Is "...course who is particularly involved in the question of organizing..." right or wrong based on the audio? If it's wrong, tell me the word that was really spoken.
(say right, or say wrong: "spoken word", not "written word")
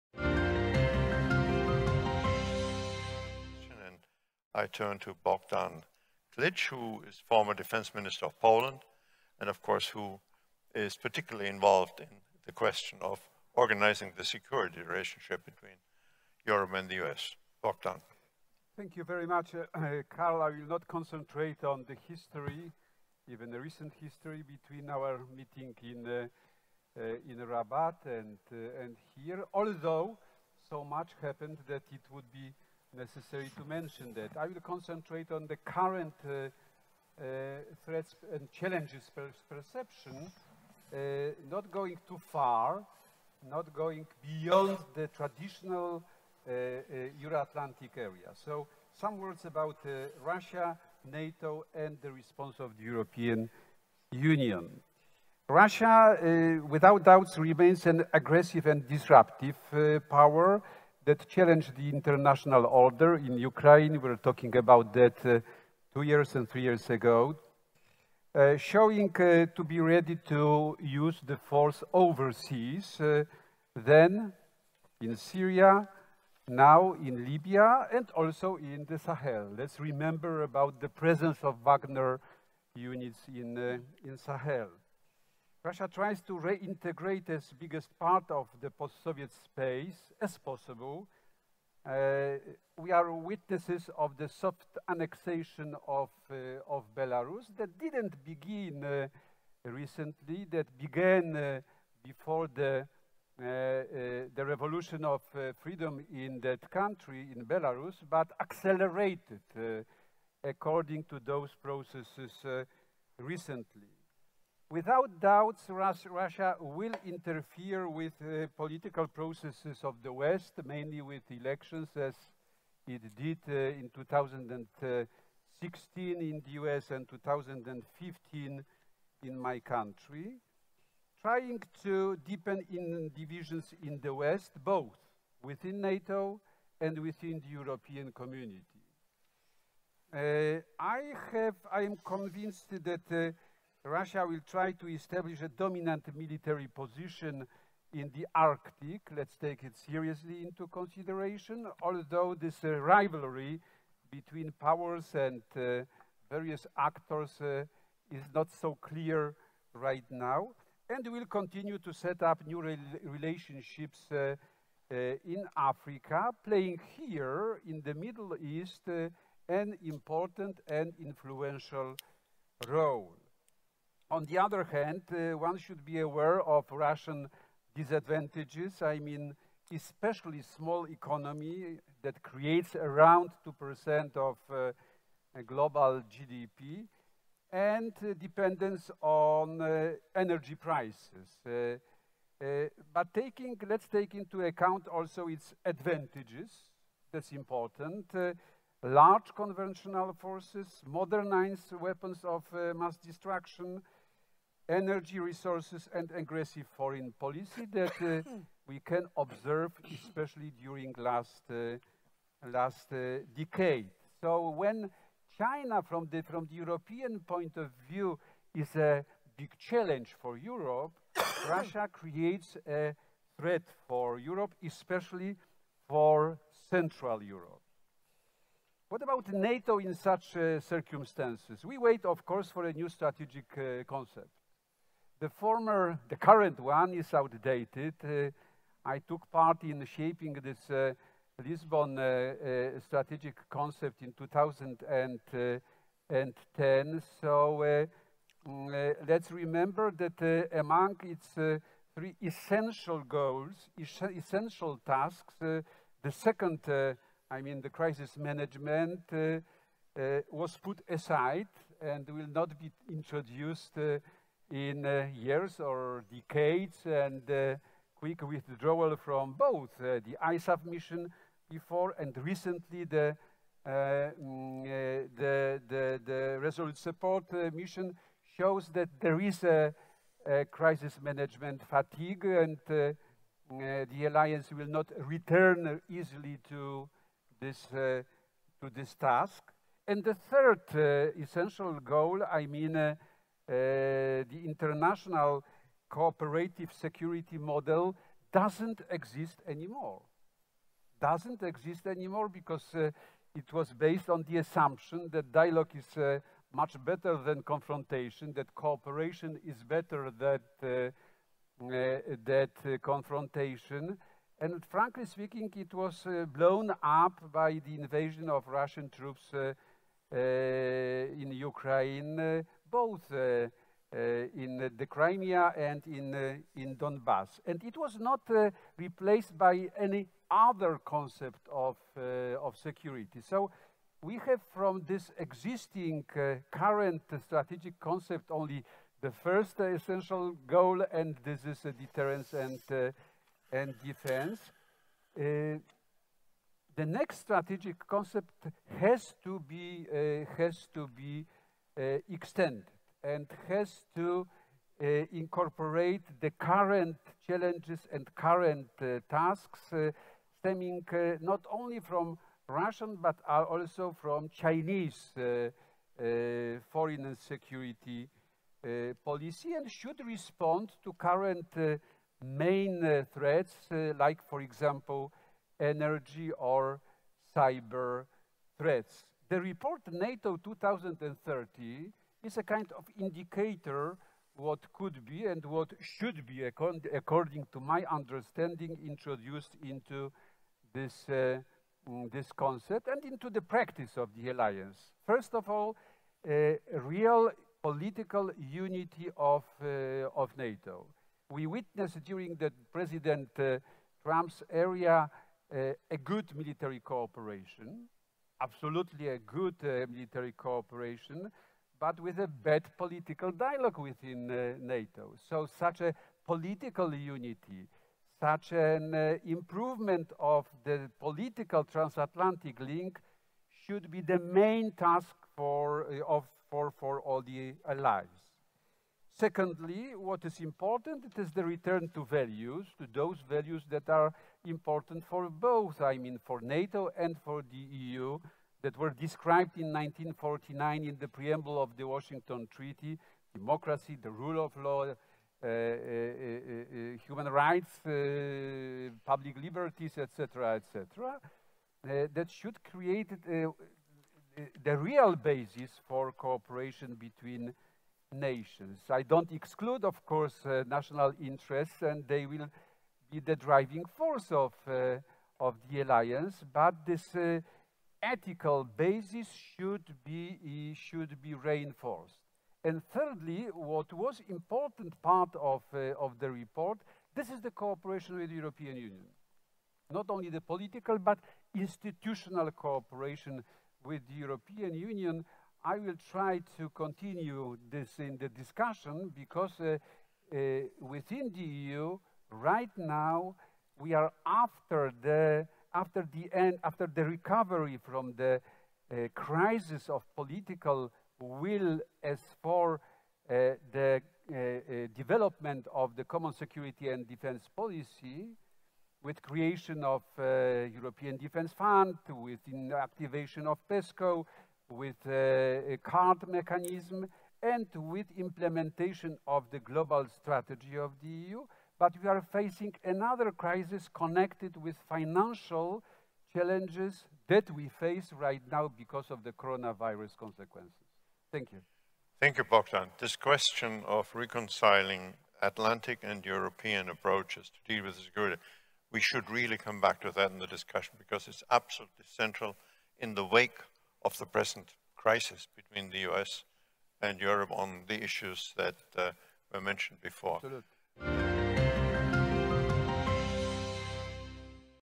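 right.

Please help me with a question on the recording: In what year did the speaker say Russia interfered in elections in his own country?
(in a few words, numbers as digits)
2015.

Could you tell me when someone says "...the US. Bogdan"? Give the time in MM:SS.
00:16.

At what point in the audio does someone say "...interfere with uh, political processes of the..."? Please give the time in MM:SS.
01:57.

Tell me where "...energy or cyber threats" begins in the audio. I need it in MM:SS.
06:15.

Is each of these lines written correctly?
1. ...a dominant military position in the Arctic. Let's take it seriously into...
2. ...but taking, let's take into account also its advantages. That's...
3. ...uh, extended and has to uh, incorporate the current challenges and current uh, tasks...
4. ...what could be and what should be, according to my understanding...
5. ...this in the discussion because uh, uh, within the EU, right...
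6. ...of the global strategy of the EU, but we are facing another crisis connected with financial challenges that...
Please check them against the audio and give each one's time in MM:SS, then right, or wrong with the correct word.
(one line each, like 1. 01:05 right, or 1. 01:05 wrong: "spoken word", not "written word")
1. 02:25 right
2. 03:12 right
3. 05:51 right
4. 06:24 right
5. 08:07 right
6. 08:39 right.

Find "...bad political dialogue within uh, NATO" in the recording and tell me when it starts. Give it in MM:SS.
06:52.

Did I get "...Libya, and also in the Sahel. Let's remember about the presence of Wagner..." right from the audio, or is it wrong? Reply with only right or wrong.
right.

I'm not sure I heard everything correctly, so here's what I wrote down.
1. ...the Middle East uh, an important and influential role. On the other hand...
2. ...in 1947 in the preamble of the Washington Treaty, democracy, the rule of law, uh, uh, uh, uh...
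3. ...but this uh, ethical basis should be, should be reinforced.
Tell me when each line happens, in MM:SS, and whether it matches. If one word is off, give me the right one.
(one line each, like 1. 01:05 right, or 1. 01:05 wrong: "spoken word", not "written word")
1. 02:47 right
2. 07:19 wrong: "1949", not "1947"
3. 07:46 right.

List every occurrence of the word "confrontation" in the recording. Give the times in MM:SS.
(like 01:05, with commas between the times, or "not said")
05:07, 05:12.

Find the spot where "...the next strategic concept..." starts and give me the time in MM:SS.
05:46.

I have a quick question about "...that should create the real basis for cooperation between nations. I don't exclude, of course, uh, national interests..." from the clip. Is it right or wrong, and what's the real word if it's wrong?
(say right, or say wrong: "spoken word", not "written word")
right.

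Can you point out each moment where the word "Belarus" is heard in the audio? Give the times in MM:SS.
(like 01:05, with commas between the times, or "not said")
01:36, 01:47.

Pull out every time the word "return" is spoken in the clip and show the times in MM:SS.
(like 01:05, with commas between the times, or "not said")
04:45, 07:11.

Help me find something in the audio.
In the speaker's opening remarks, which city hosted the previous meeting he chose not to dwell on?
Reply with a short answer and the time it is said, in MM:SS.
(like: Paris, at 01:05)
Rabat, at 00:27.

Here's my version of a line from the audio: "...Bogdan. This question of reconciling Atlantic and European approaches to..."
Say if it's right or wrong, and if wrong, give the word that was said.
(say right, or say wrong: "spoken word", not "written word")
right.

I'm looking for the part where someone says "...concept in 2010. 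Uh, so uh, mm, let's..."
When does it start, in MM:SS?
04:03.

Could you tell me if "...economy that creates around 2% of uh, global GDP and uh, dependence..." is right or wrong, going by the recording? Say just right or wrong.
right.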